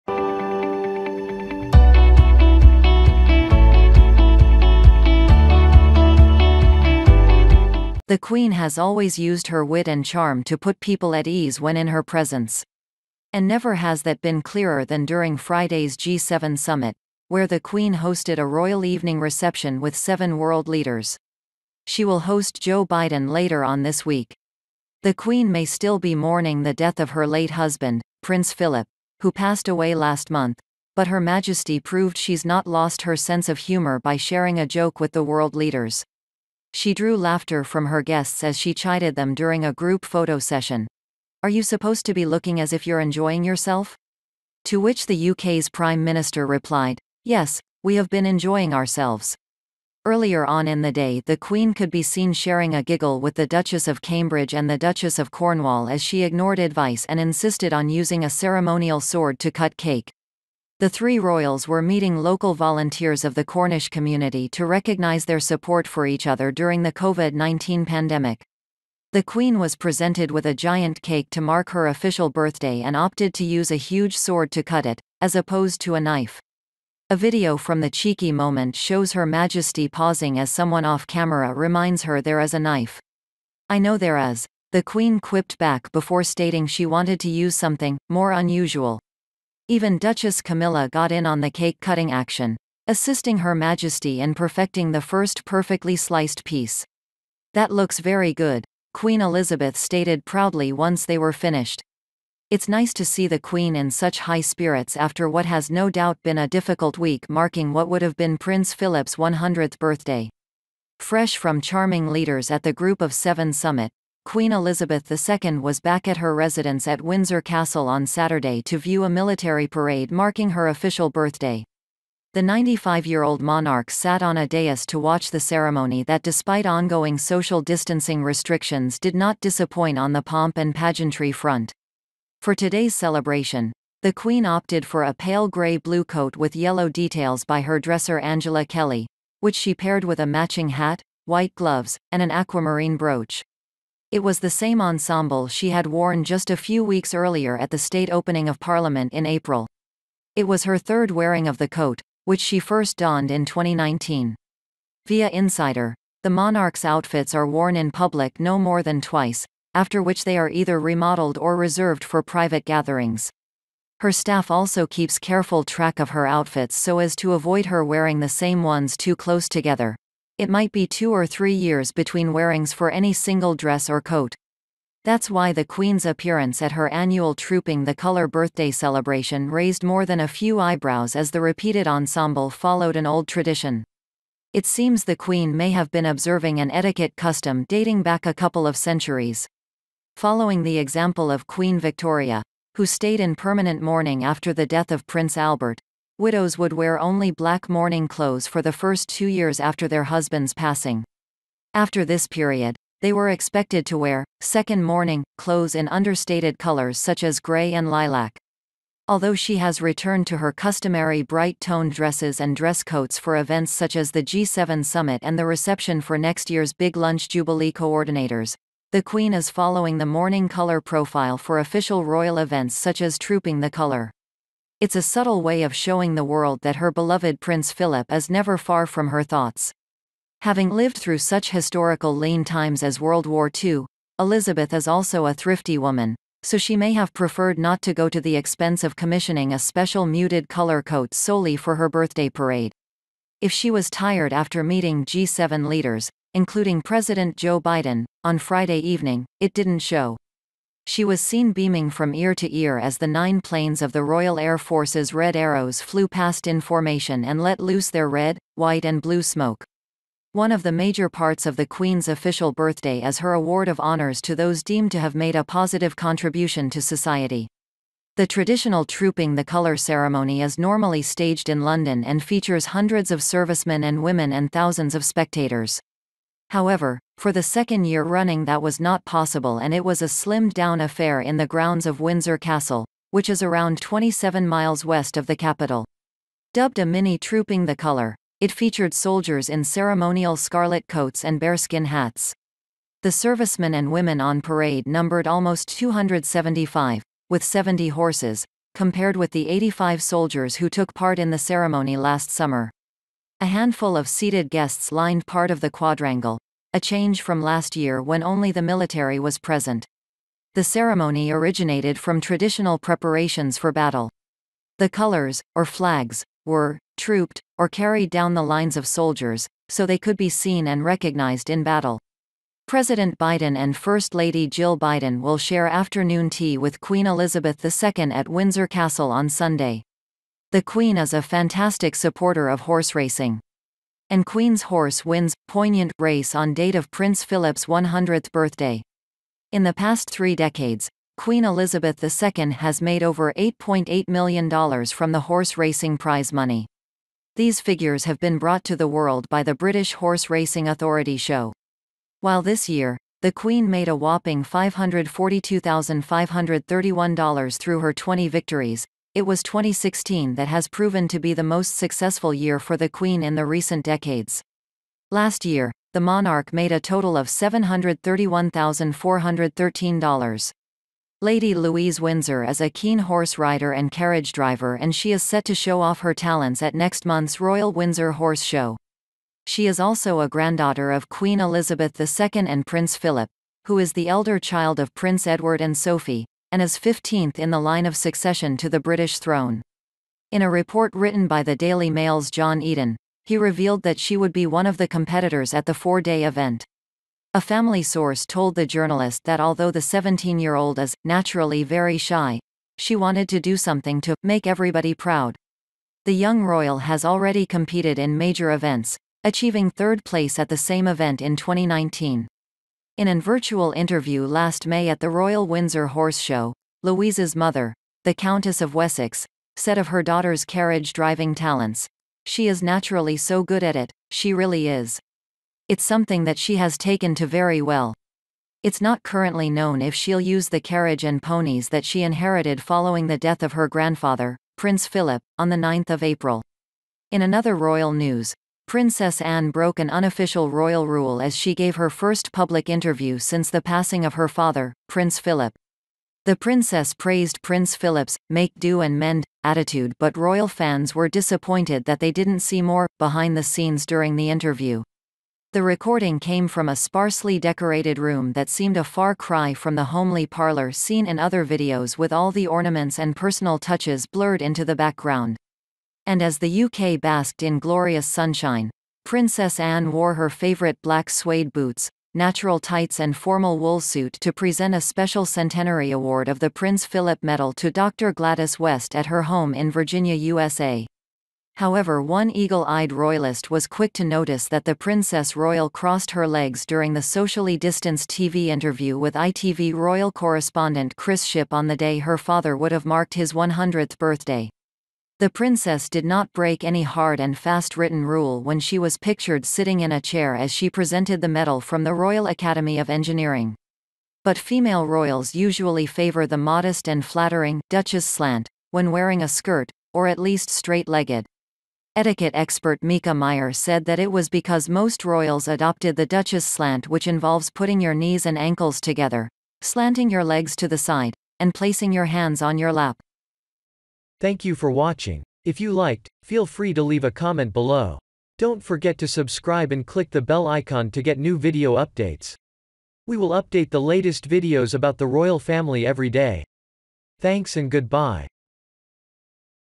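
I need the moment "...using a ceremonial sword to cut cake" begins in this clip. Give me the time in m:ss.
0:57.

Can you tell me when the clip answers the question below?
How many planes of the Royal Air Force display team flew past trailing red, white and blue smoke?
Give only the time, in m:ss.
4:13.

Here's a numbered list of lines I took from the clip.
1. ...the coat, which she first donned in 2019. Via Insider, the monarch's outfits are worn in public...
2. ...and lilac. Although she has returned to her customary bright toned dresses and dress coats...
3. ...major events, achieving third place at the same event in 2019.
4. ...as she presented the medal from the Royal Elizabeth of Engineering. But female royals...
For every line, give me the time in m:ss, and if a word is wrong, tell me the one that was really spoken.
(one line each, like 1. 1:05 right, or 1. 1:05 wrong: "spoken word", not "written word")
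1. 2:31 right
2. 3:27 right
3. 6:48 right
4. 8:20 wrong: "Academy", not "Elizabeth".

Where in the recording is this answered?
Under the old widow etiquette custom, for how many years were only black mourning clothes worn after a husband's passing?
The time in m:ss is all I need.
3:19.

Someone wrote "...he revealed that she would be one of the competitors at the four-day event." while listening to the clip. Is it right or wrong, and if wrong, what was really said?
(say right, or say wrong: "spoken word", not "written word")
right.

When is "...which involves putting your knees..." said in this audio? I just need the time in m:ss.
8:36.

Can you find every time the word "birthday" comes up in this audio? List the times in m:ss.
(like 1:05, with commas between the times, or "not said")
1:12, 1:49, 2:01, 2:58, 4:01, 4:22, 5:38, 8:13.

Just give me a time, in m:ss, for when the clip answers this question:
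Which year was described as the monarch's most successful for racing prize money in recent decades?
5:59.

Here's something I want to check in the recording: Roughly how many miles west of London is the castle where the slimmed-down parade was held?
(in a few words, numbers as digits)
27.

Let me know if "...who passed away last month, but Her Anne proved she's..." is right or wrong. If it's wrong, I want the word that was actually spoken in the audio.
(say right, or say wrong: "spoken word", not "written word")
wrong: "Majesty", not "Anne".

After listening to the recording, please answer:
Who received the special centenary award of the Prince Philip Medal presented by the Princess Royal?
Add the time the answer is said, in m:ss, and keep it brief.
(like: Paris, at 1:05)
Dr. Gladys West, at 7:57.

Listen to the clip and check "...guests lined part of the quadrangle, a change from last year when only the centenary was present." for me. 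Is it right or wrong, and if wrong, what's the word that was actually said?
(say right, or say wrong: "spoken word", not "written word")
wrong: "military", not "centenary".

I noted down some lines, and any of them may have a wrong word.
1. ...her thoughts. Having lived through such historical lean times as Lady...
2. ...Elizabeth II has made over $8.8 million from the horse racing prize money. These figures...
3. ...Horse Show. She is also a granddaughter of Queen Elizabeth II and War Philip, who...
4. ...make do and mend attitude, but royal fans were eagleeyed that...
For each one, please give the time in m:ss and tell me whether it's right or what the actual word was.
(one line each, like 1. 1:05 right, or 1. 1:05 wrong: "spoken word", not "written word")
1. 3:49 wrong: "World", not "Lady"
2. 5:41 right
3. 6:18 wrong: "Prince", not "War"
4. 7:28 wrong: "disappointed", not "eagleeyed".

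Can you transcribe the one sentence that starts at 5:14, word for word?
The colors, or flags, were trooped or carried down the lines of soldiers, so they could be seen and recognized in battle.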